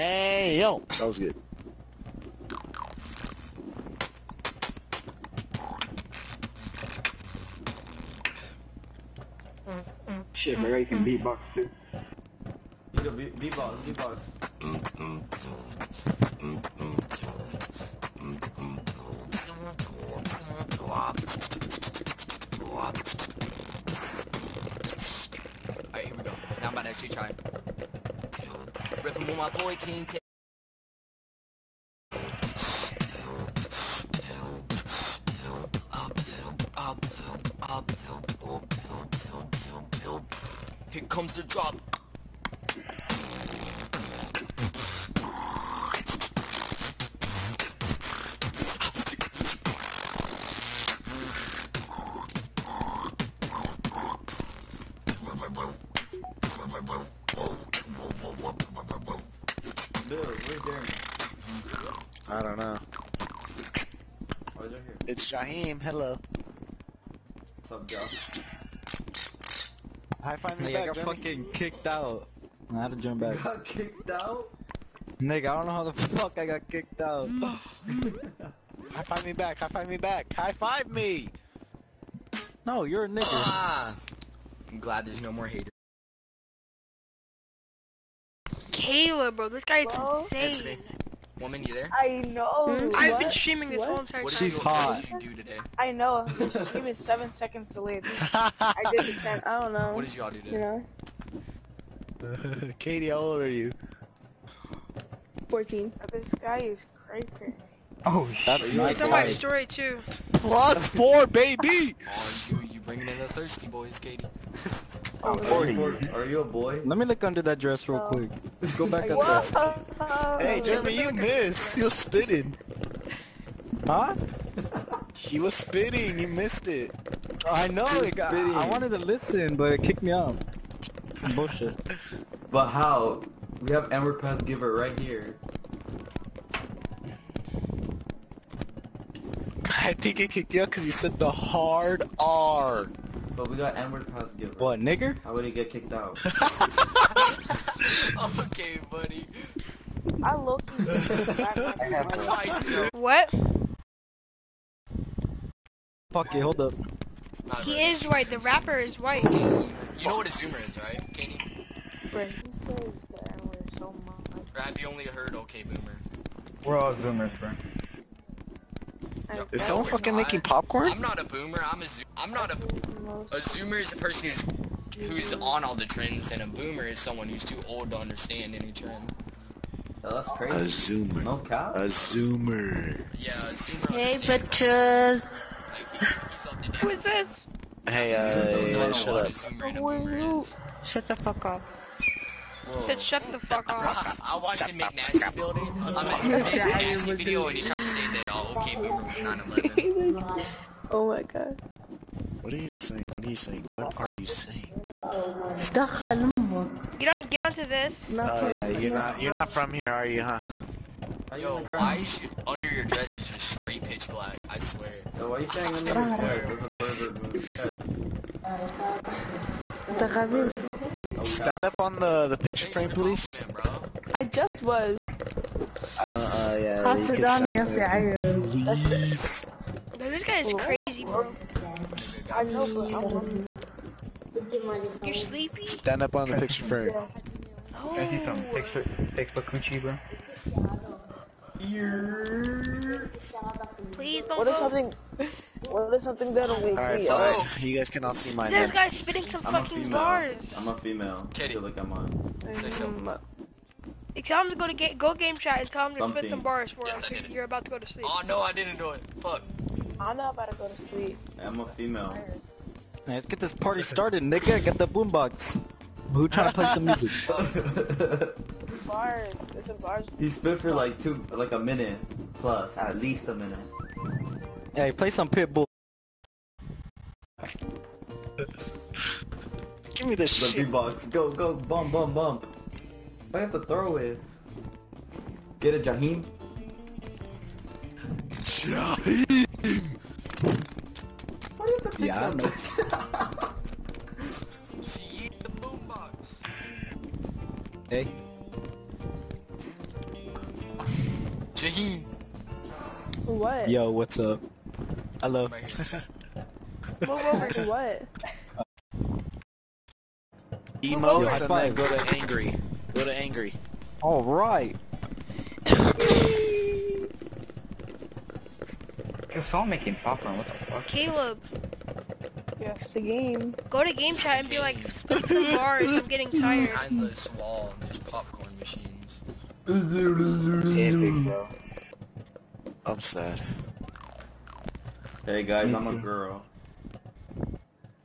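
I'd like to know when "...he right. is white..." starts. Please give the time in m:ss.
2:37.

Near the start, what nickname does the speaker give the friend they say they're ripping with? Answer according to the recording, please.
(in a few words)
King T.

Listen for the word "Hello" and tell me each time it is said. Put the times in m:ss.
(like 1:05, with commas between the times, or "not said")
1:05, 5:05.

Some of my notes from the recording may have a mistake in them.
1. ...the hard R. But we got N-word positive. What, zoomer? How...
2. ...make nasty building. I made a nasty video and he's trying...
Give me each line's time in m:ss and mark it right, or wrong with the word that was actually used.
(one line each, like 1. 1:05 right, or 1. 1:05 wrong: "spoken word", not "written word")
1. 2:21 wrong: "nigger", not "zoomer"
2. 3:14 right.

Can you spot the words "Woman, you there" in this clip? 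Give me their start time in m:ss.
1:31.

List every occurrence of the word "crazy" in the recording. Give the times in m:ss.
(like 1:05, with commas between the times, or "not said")
1:47, 3:00, 3:50.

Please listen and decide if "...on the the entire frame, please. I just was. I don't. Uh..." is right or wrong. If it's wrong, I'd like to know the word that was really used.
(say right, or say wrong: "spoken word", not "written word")
wrong: "picture", not "entire".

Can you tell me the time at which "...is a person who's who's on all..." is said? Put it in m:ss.
2:53.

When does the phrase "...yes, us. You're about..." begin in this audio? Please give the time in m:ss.
4:16.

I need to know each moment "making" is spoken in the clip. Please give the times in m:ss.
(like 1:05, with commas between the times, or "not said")
2:50, 5:19.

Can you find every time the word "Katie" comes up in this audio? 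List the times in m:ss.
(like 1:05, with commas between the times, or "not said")
1:42, 1:53, 2:41.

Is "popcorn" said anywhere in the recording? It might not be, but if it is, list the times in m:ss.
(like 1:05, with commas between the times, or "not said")
2:50, 5:20.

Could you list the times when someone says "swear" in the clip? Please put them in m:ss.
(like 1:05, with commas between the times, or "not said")
3:34.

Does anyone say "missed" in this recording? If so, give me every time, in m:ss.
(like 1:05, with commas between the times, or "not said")
2:01, 2:06.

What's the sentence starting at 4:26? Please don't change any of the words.
Who trying to play some music?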